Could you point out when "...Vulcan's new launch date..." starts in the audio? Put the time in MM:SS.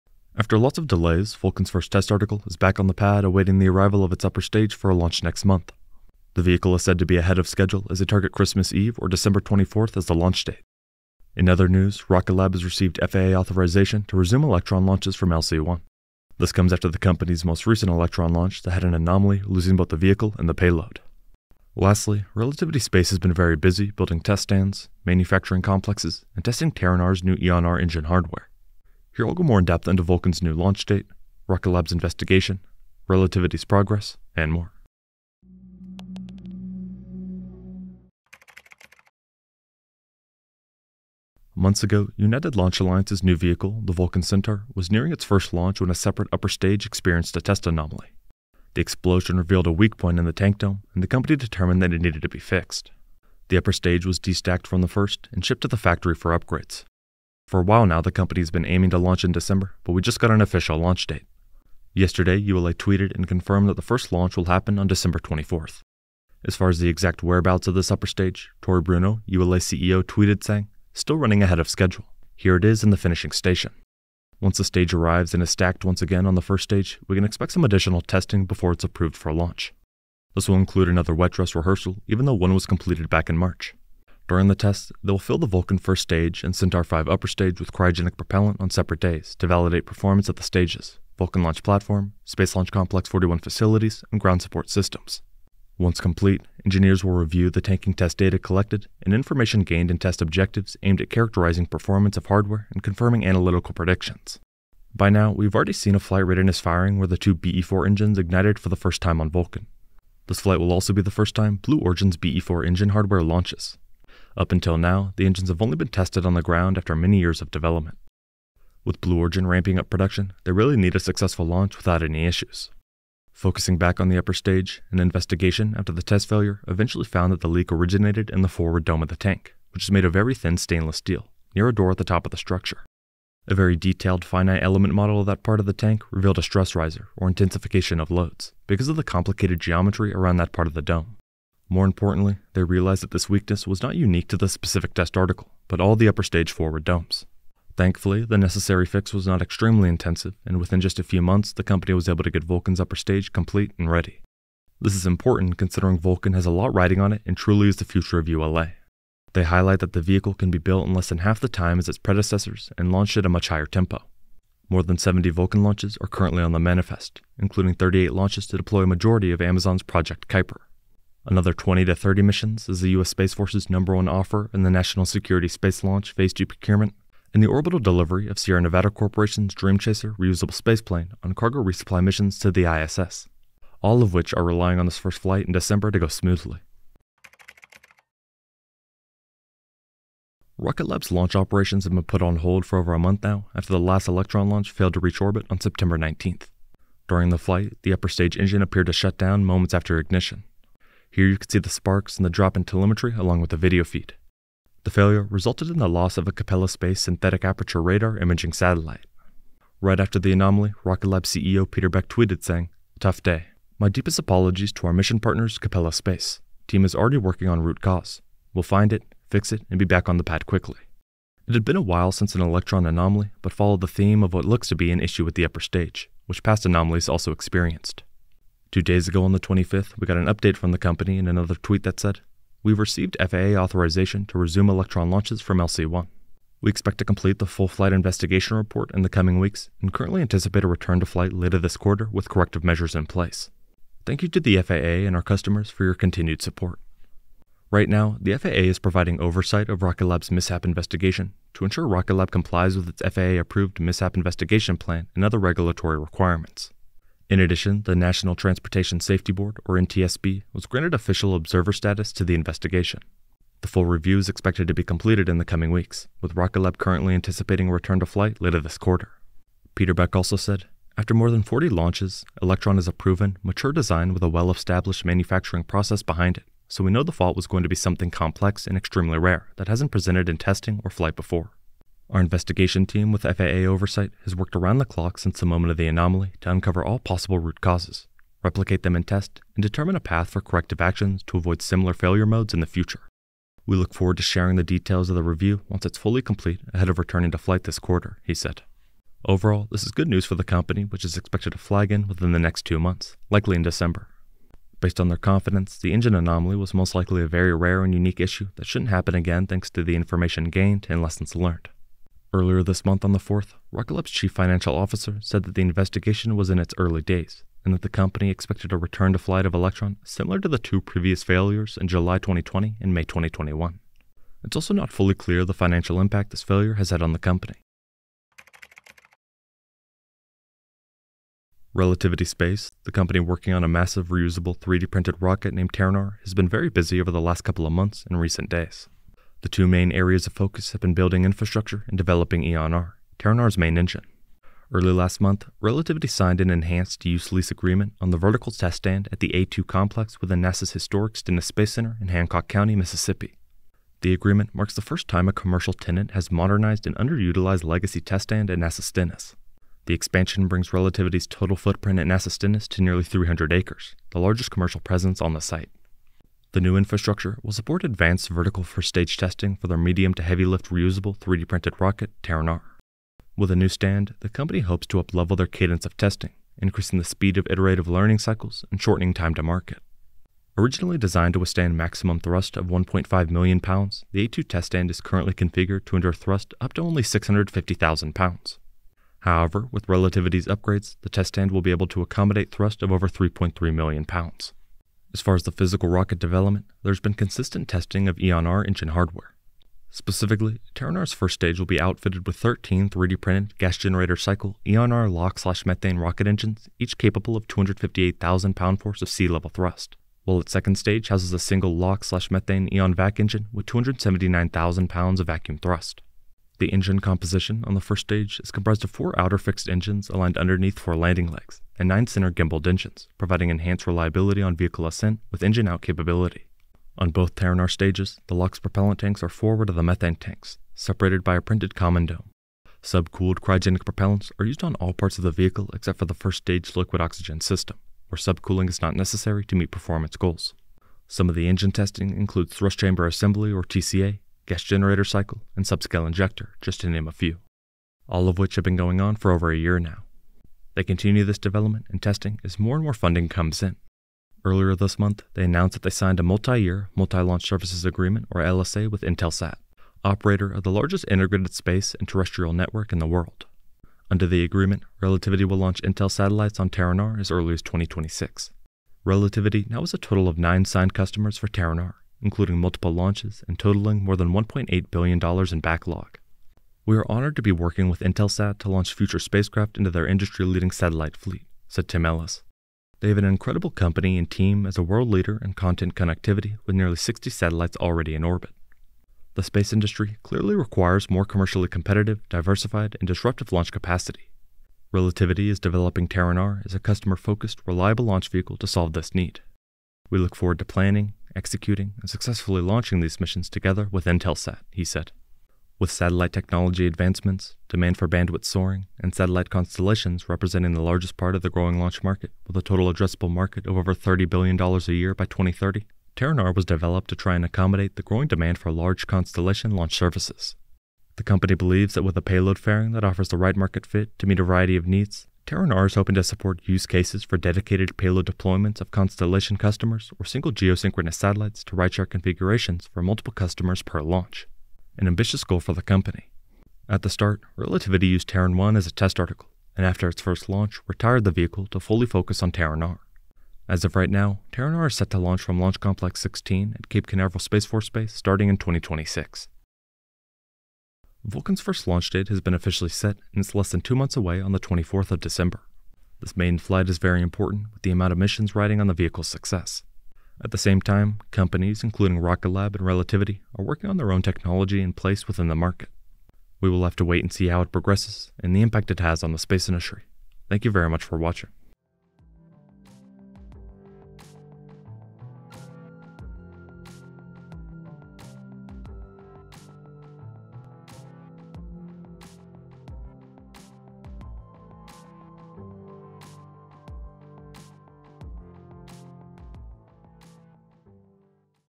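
00:30.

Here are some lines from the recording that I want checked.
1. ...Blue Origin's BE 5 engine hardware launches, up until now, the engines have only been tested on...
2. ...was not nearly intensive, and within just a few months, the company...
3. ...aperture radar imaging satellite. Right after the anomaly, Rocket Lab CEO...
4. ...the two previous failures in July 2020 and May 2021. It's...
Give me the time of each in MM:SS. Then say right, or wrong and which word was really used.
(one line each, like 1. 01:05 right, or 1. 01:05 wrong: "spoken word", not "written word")
1. 01:51 wrong: "4", not "5"
2. 02:29 wrong: "extremely", not "nearly"
3. 03:27 right
4. 05:20 right.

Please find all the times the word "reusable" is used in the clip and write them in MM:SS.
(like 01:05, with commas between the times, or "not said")
03:00, 05:34, 06:10.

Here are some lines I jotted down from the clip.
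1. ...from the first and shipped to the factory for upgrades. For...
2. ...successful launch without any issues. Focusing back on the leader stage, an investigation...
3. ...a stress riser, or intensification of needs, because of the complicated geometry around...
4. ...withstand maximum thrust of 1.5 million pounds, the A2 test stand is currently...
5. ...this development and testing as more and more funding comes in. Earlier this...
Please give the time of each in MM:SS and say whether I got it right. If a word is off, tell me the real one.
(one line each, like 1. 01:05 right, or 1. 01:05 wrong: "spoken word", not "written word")
1. 00:54 right
2. 02:00 wrong: "upper", not "leader"
3. 02:16 wrong: "loads", not "needs"
4. 06:21 right
5. 07:31 right.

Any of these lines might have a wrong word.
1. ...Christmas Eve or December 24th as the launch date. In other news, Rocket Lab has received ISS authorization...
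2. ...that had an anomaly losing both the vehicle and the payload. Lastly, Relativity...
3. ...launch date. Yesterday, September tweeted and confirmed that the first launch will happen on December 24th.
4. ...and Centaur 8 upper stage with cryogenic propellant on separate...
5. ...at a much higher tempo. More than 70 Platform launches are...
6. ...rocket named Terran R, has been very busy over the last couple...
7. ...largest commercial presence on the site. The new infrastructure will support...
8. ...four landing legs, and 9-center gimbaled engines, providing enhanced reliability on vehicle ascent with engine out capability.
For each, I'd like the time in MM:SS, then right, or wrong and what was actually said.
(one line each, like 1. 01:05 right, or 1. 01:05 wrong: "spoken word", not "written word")
1. 00:08 wrong: "FAA", not "ISS"
2. 00:18 right
3. 01:00 wrong: "ULA", not "September"
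4. 01:26 wrong: "5", not "8"
5. 02:43 wrong: "Vulcan", not "Platform"
6. 05:35 right
7. 06:04 right
8. 07:00 right.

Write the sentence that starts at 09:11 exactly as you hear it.
Vulcan's first launch date has been officially set and it's less than two months away on the 24th of December.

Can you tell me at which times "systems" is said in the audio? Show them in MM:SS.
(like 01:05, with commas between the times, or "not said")
01:34, 07:17.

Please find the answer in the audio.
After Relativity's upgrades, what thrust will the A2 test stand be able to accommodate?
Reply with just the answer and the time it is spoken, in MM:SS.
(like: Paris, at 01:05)
over 3.3 million pounds, at 06:33.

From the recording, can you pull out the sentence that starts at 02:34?
This is important considering Vulcan has a lot riding on it and truly is the future of ULA.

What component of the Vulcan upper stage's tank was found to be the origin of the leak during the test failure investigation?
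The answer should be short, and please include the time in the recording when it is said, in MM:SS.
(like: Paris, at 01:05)
forward dome, at 02:08.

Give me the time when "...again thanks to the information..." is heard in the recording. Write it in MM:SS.
05:09.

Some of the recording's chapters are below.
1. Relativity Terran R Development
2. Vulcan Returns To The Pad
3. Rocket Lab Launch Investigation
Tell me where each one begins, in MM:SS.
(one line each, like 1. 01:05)
1. 05:28
2. 00:37
3. 03:07.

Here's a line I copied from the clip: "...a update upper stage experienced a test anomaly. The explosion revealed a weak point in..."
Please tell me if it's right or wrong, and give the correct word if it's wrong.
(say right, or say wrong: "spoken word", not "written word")
wrong: "separate", not "update".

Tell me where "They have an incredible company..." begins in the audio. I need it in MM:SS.
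08:03.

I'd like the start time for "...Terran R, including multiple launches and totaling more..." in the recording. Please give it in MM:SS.
07:51.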